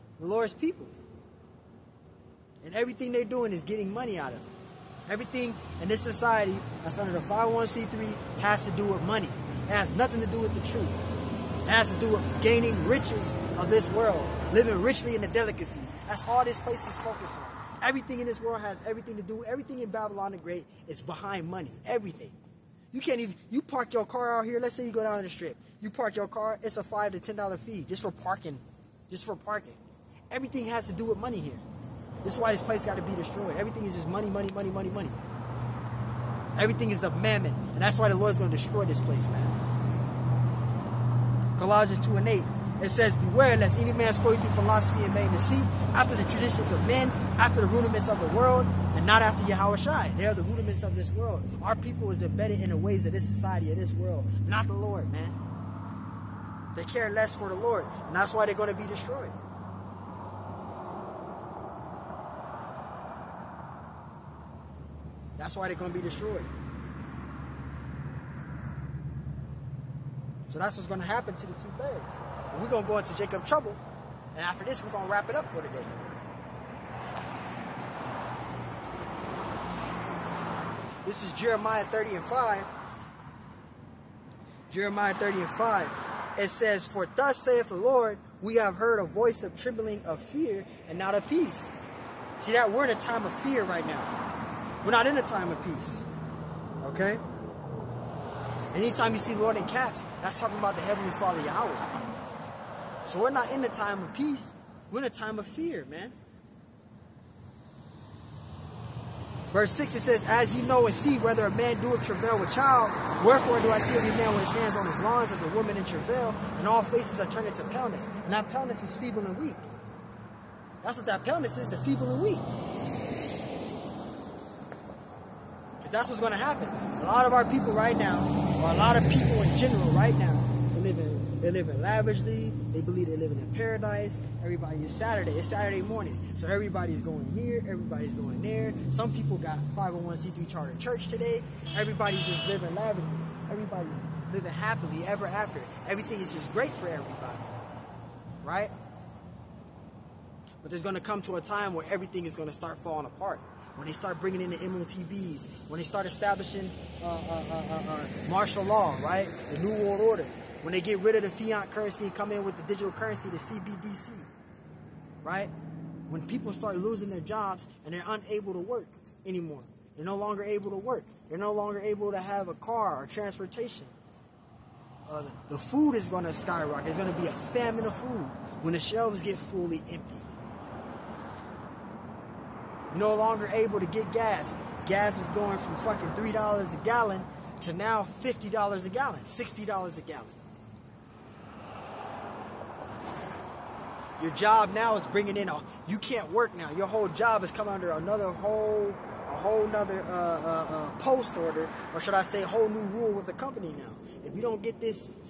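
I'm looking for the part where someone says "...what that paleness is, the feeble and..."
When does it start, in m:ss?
2:00.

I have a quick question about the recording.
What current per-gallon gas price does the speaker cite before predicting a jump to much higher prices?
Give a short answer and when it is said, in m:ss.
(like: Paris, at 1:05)
$3 a gallon, at 3:06.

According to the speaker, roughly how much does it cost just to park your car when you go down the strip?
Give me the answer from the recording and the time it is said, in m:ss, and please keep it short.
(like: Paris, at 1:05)
$5 to $10, at 0:26.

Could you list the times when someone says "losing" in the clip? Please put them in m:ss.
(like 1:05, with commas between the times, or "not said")
2:46.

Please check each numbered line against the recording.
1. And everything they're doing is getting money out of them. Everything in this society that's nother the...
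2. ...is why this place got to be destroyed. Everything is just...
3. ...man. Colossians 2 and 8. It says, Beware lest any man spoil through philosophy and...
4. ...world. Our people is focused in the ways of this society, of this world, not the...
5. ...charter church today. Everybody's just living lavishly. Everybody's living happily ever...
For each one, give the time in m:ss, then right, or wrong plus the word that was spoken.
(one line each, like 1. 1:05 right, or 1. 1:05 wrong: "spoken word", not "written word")
1. 0:02 wrong: "under", not "nother"
2. 0:32 right
3. 0:39 right
4. 0:51 wrong: "embedded", not "focused"
5. 2:20 right.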